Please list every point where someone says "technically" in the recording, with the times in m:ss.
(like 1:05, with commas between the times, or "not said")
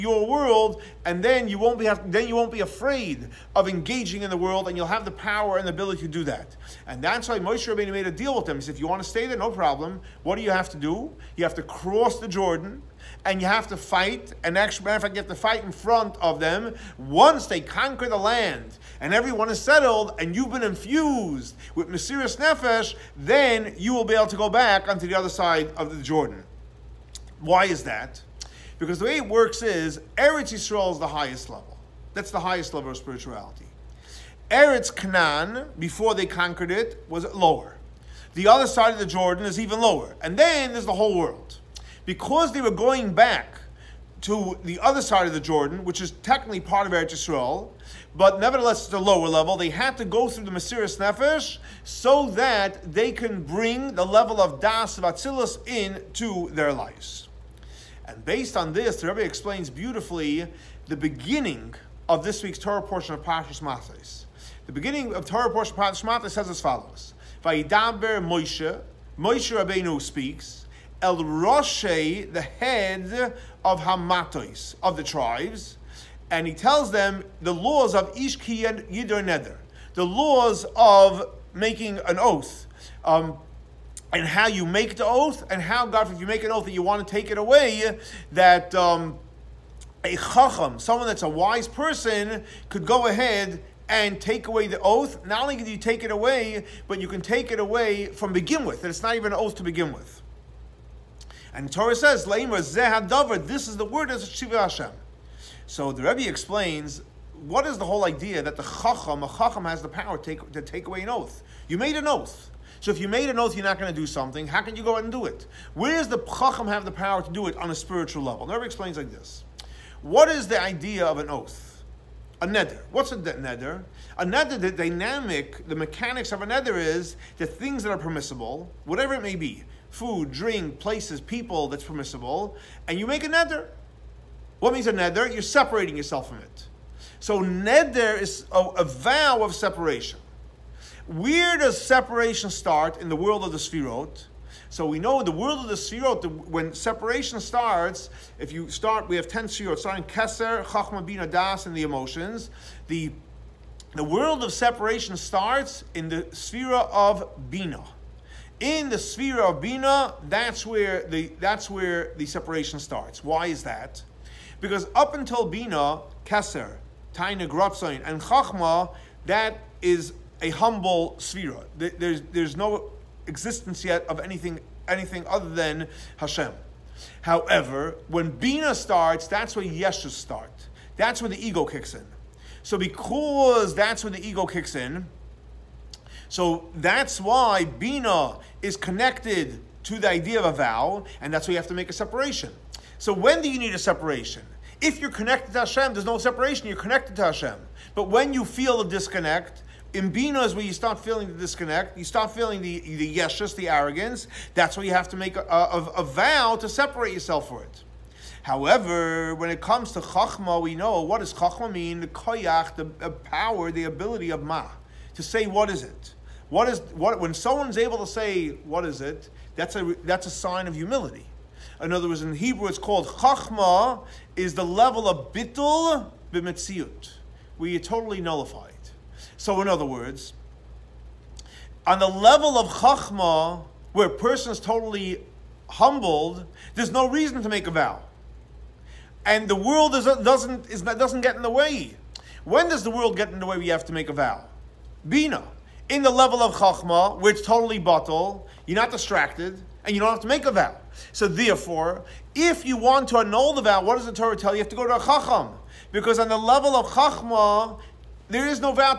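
0:46.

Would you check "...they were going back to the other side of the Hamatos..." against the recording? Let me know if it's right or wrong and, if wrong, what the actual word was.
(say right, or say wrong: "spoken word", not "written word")
wrong: "Jordan", not "Hamatos".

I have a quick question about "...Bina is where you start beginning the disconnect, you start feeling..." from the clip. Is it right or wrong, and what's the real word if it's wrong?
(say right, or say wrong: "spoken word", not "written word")
wrong: "feeling", not "beginning".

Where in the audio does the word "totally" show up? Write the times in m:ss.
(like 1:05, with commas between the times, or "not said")
3:47, 3:54, 4:07.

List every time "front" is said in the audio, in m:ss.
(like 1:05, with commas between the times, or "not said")
0:15.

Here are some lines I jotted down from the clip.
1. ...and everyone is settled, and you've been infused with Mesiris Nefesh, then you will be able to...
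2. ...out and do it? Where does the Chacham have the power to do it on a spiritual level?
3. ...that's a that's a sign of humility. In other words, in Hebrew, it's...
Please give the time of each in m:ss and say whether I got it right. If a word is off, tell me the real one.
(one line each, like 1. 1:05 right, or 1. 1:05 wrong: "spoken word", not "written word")
1. 0:18 right
2. 1:54 right
3. 3:39 right.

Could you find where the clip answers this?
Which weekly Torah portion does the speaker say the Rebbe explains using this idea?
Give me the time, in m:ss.
1:03.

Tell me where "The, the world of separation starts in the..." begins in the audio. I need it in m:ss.
2:32.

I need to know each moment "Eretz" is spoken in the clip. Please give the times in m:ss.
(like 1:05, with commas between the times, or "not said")
0:30, 0:34, 0:46.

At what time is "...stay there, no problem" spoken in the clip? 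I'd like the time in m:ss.
0:09.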